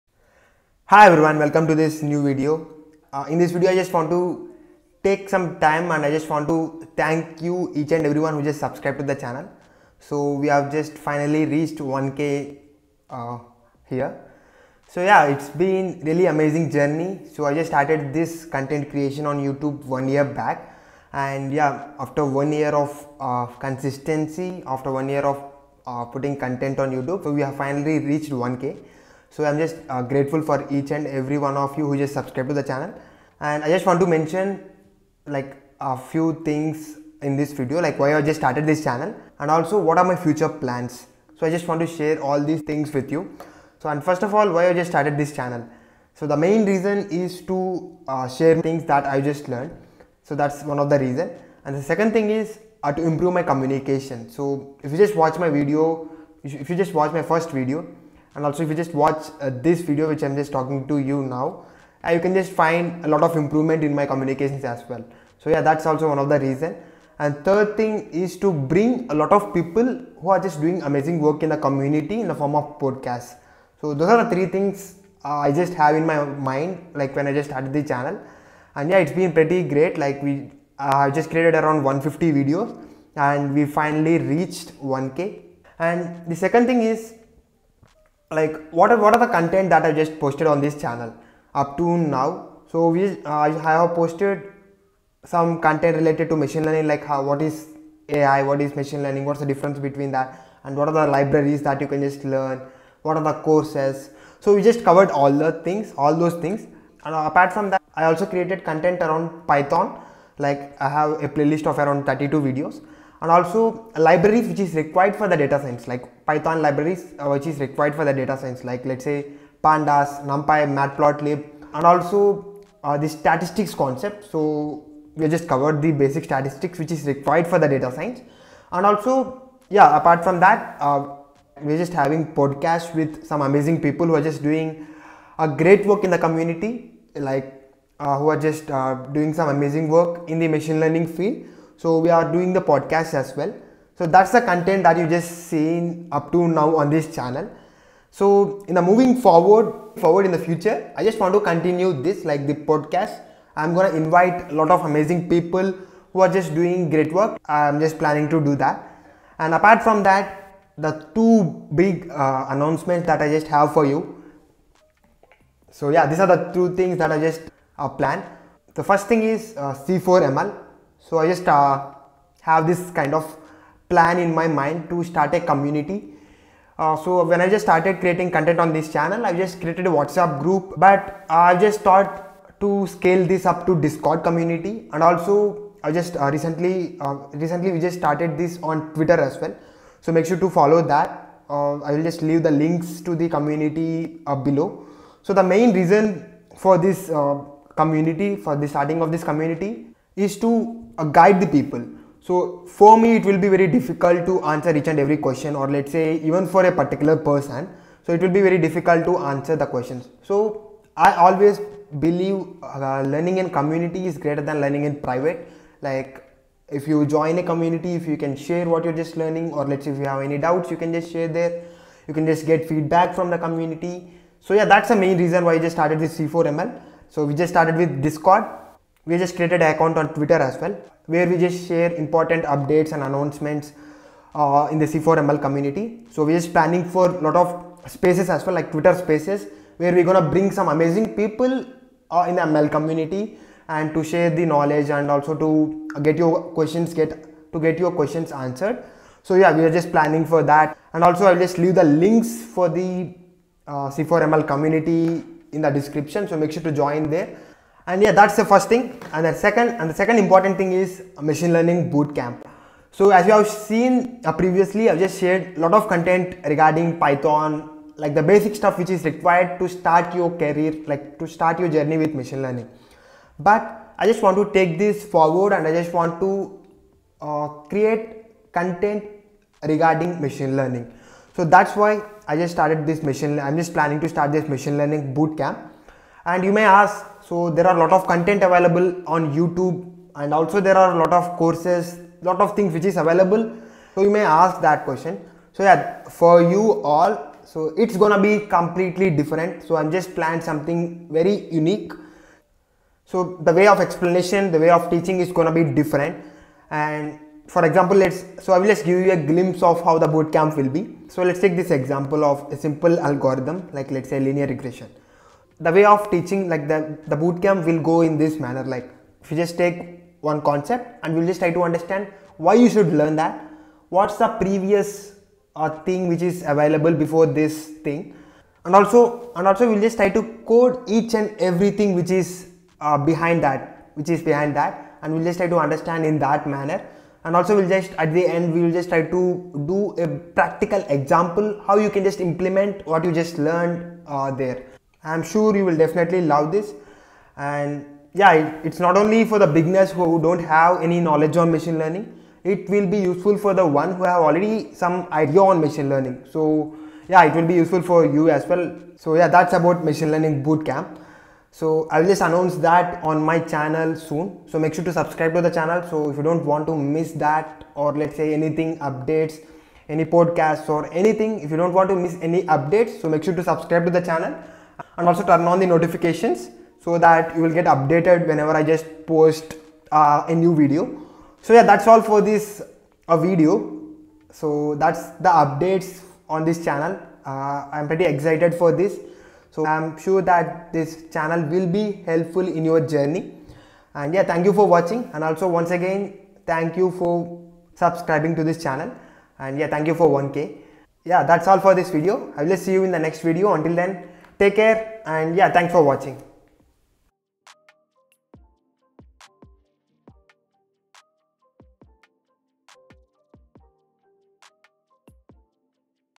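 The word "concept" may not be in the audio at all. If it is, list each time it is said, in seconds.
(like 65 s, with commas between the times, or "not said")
123 s, 320 s.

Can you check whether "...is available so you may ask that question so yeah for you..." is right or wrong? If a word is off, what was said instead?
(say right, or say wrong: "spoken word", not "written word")
right.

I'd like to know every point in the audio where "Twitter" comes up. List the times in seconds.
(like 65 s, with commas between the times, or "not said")
188 s, 230 s, 238 s.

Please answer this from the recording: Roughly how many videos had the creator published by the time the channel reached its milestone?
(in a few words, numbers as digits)
150.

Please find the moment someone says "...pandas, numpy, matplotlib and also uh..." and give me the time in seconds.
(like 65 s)
119 s.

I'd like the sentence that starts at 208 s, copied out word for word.
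So it will be very difficult to answer the questions.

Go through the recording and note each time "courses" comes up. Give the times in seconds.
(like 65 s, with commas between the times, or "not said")
103 s, 291 s.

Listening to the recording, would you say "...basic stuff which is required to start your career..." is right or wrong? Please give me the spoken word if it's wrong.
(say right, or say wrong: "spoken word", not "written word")
right.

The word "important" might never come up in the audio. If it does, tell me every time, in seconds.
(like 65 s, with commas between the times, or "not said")
231 s, 260 s.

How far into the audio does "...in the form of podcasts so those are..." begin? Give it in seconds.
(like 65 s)
72 s.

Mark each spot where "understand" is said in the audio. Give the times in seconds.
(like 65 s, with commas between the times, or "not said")
321 s, 335 s.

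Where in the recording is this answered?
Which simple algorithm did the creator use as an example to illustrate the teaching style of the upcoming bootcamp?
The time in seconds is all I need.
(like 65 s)
314 s.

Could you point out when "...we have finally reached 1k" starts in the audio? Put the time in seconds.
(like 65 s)
27 s.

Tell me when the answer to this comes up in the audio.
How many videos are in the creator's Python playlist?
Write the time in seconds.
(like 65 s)
111 s.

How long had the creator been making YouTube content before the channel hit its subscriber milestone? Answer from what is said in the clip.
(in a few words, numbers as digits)
1 year.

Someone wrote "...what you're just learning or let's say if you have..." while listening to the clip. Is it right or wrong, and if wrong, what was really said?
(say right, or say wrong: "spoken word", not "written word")
right.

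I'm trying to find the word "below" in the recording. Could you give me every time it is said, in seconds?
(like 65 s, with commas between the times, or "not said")
194 s.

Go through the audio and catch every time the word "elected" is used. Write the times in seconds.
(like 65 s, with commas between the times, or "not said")
not said.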